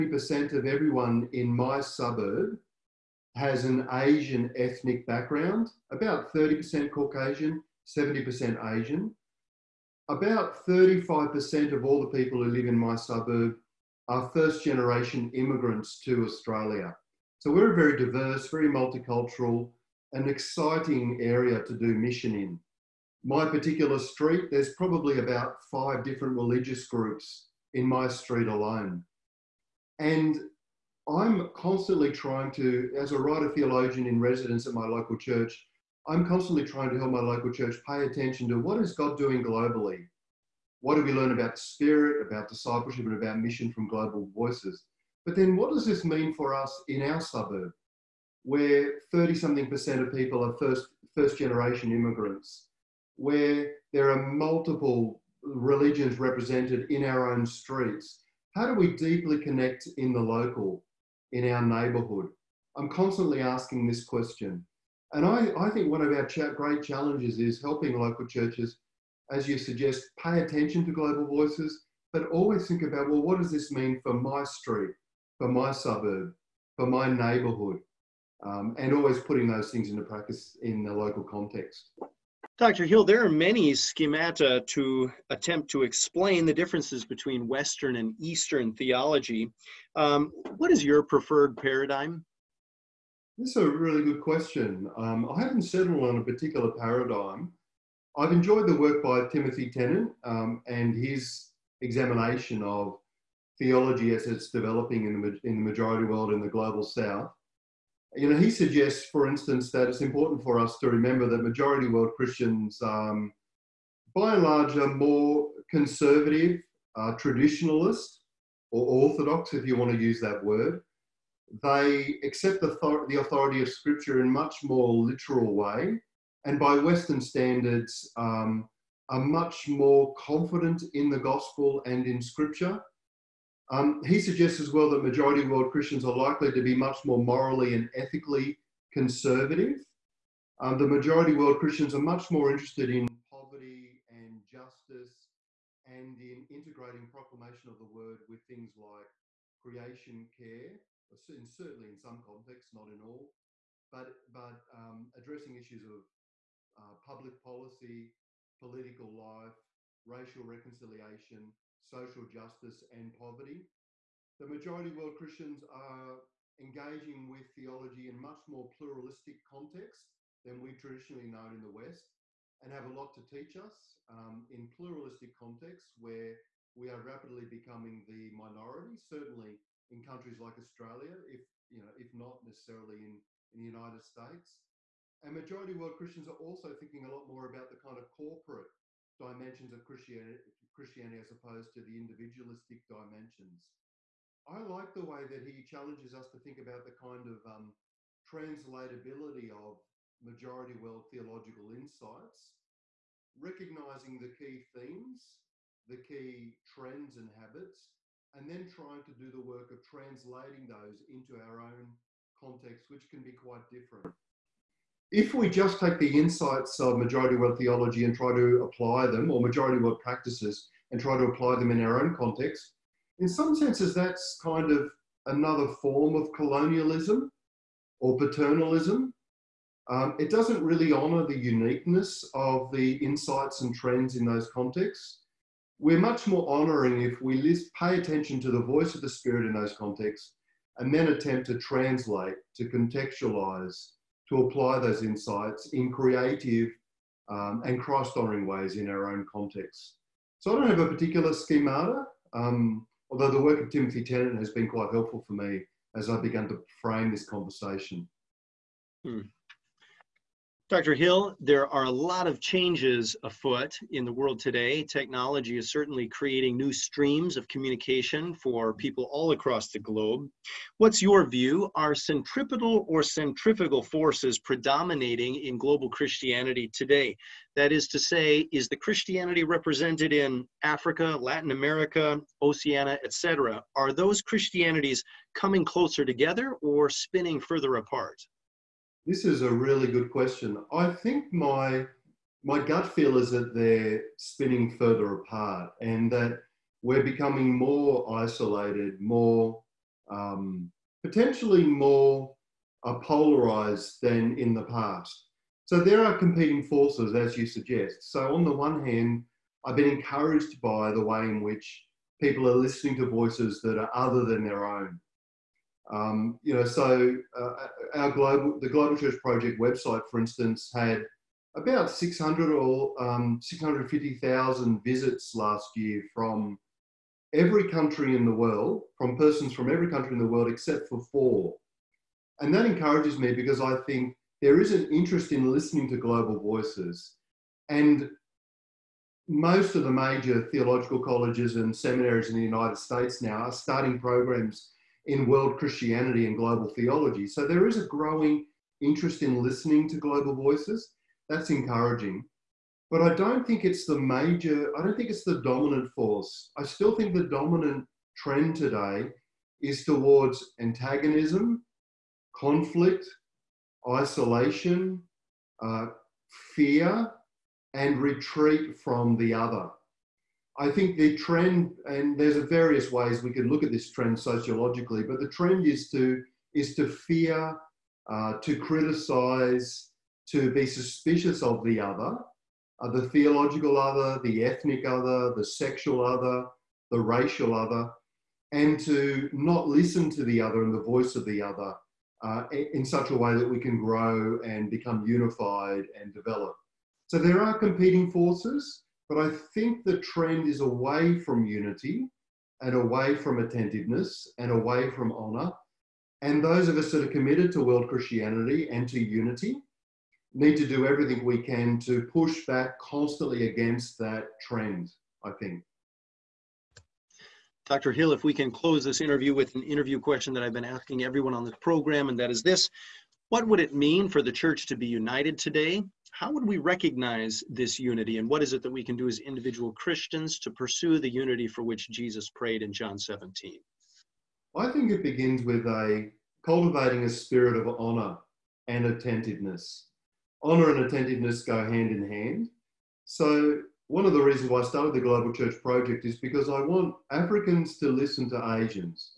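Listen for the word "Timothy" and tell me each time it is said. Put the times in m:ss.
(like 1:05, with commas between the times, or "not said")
1:39, 4:13.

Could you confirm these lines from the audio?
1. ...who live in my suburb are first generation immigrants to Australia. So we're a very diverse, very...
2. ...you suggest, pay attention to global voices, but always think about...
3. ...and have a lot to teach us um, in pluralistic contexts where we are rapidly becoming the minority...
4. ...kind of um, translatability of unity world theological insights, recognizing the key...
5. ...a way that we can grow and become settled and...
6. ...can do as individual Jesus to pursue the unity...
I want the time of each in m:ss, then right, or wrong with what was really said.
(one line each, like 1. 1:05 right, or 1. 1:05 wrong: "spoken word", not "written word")
1. 0:12 right
2. 1:09 right
3. 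2:52 right
4. 3:16 wrong: "majority", not "unity"
5. 6:33 wrong: "unified", not "settled"
6. 7:08 wrong: "Christians", not "Jesus".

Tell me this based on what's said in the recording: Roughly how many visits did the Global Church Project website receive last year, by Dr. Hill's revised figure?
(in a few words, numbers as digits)
650,000.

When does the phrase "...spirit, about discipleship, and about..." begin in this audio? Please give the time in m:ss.
0:41.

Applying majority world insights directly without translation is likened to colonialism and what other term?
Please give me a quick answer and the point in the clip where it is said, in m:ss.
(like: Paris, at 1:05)
paternalism, at 3:48.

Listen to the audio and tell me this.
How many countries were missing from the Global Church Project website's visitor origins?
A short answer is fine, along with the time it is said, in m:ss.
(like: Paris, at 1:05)
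4, at 5:31.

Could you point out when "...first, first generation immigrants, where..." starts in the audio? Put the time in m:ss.
0:50.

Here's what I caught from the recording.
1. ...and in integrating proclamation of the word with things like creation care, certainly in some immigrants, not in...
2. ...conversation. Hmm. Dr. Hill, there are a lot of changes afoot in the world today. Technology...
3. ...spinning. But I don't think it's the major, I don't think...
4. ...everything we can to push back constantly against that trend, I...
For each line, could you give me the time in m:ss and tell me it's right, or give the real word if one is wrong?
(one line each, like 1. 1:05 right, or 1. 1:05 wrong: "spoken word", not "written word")
1. 2:25 wrong: "contexts", not "immigrants"
2. 4:17 right
3. 5:51 wrong: "encouraging", not "spinning"
4. 6:50 right.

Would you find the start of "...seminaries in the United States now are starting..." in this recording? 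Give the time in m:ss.
5:41.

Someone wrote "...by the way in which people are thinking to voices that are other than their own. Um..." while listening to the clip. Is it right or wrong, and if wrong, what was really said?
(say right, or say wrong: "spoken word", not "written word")
wrong: "listening", not "thinking".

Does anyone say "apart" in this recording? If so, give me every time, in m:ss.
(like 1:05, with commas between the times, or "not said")
4:47, 4:55.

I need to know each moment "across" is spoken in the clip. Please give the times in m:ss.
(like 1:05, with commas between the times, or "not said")
4:29.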